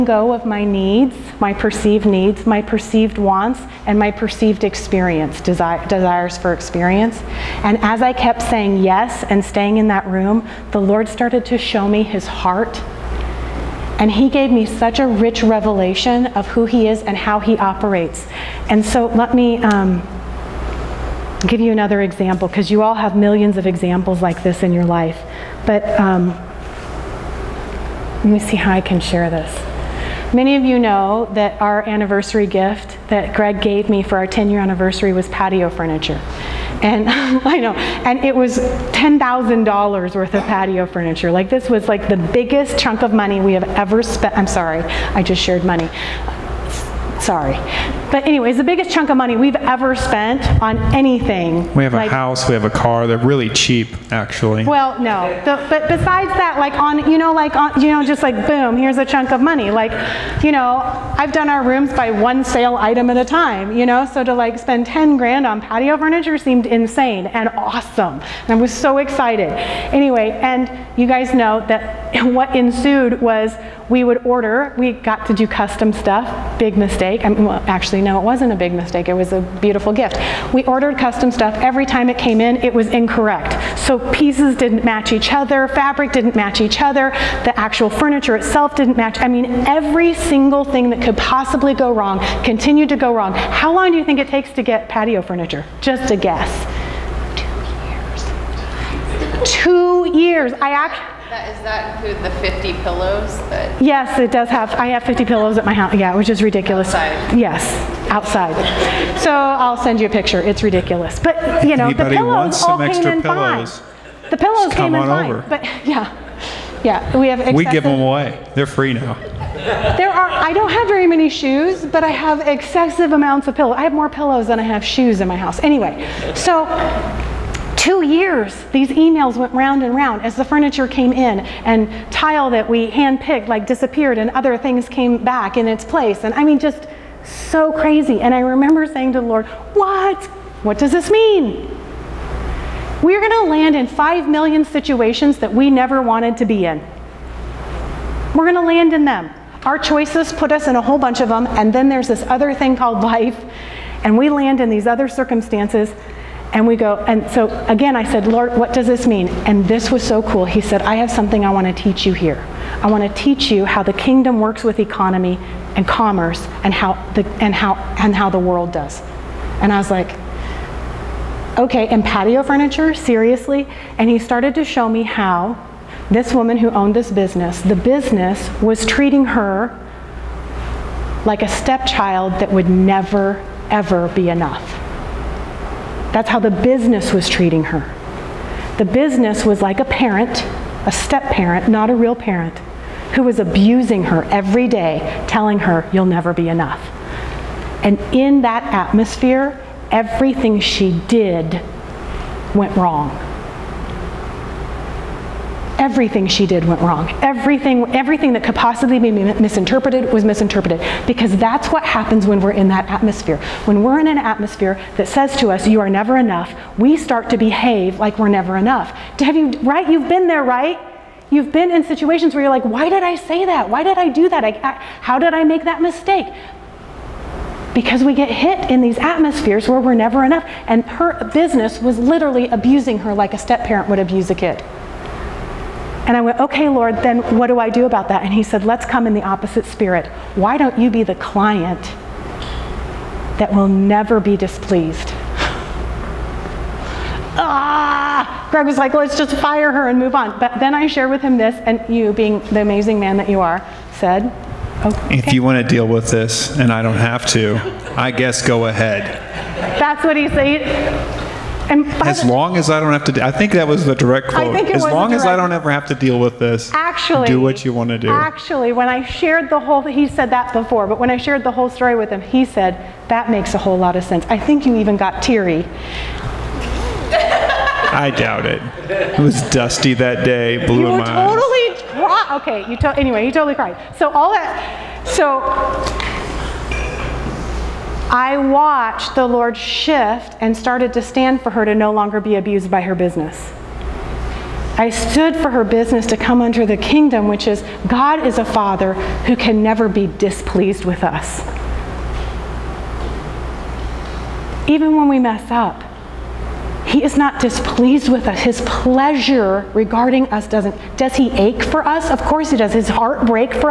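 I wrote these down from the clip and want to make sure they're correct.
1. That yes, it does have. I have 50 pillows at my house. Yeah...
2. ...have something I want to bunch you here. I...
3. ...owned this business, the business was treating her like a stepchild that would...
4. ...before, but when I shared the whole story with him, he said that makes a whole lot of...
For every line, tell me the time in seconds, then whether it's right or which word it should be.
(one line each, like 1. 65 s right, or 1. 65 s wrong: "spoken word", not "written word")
1. 103 s right
2. 160 s wrong: "teach", not "bunch"
3. 176 s right
4. 270 s right.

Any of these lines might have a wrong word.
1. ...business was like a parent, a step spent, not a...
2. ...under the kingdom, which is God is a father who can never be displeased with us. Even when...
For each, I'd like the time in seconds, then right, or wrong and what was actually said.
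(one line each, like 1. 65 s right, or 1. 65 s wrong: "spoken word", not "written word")
1. 188 s wrong: "parent", not "spent"
2. 296 s right.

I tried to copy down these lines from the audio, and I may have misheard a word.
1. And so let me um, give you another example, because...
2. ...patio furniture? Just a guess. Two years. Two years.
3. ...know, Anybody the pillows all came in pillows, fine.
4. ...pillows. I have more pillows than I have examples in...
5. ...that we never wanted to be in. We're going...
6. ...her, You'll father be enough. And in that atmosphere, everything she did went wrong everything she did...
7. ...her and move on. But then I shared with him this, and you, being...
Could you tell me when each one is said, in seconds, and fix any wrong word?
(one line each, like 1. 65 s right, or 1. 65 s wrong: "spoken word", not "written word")
1. 18 s right
2. 94 s right
3. 111 s right
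4. 123 s wrong: "shoes", not "examples"
5. 145 s right
6. 195 s wrong: "never", not "father"
7. 249 s right.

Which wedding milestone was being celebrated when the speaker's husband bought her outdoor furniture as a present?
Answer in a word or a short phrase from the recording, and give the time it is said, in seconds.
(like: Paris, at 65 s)
10 year anniversary, at 34 s.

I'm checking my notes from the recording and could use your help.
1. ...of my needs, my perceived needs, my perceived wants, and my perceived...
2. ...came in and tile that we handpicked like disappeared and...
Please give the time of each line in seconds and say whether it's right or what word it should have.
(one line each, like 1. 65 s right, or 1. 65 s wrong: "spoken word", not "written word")
1. 0 s right
2. 130 s right.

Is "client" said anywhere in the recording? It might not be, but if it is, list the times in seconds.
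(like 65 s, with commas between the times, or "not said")
241 s.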